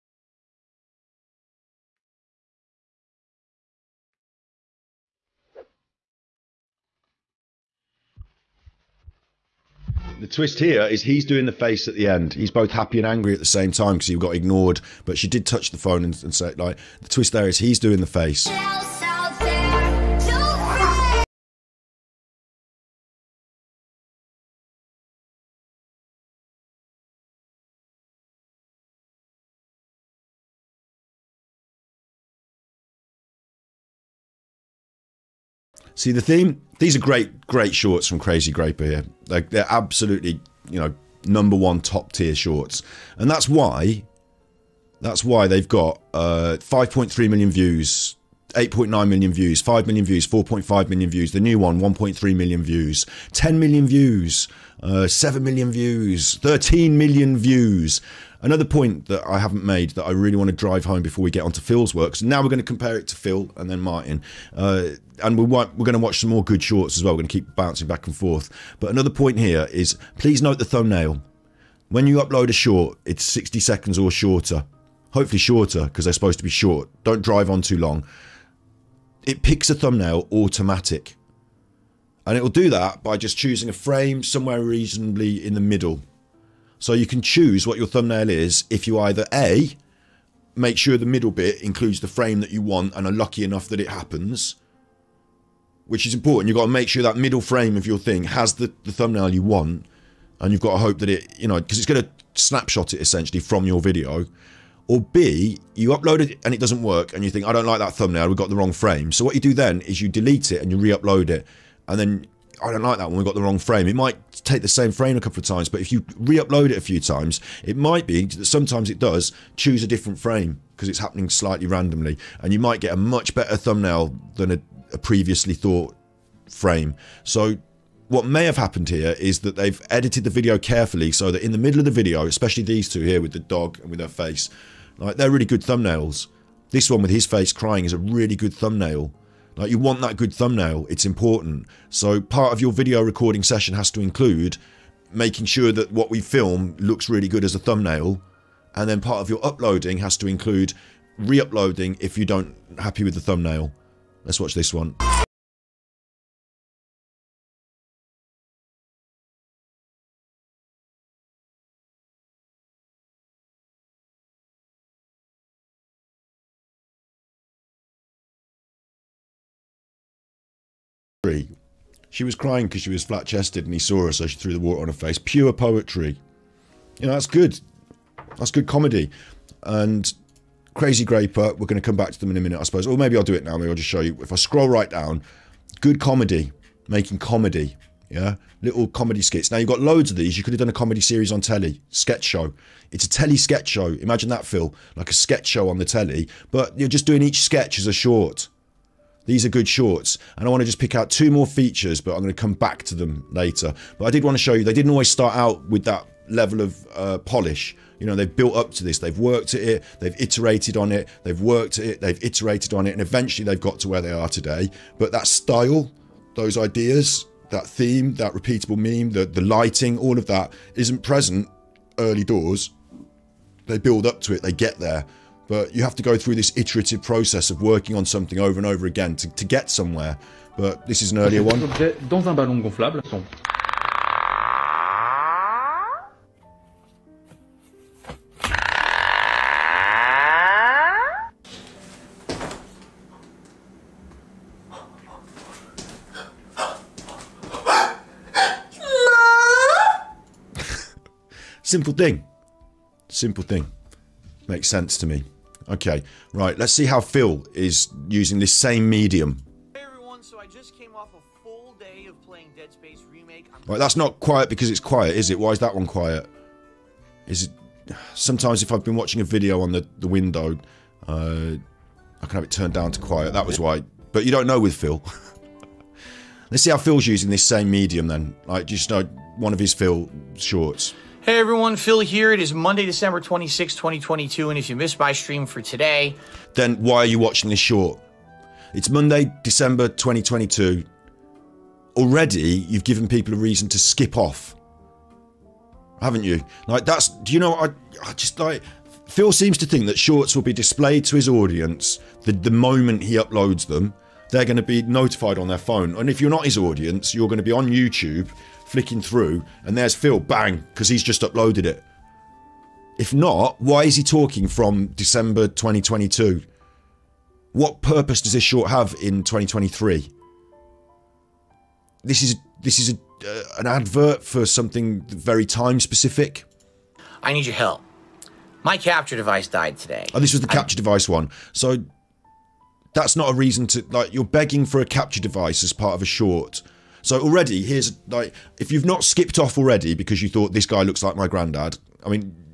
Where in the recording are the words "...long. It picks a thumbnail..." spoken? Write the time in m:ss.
1:17.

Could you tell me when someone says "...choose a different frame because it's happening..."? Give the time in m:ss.
1:59.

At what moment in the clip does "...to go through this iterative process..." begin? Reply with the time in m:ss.
3:45.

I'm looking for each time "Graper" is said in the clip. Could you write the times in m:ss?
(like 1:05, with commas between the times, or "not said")
0:38, 3:01.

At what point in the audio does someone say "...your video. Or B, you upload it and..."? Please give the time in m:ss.
1:43.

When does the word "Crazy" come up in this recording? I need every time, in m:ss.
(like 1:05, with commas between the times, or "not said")
0:38, 3:00.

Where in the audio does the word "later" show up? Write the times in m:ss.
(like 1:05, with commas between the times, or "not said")
3:23.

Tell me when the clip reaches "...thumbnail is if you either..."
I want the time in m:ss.
1:27.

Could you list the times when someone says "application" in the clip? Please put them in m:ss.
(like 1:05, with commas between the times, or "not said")
not said.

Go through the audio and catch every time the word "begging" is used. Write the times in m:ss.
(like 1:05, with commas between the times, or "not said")
5:34.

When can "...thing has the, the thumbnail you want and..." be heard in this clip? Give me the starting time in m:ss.
1:37.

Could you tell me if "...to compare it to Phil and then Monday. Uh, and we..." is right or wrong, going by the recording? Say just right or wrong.
wrong.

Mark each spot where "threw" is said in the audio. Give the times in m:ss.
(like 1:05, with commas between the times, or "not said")
2:54.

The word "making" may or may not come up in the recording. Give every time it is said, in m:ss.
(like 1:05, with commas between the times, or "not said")
2:25, 3:06.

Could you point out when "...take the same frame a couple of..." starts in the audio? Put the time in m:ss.
1:54.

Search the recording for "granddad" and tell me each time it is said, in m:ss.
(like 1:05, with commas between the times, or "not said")
5:41.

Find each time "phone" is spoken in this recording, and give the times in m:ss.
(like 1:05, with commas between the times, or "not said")
0:15, 5:05.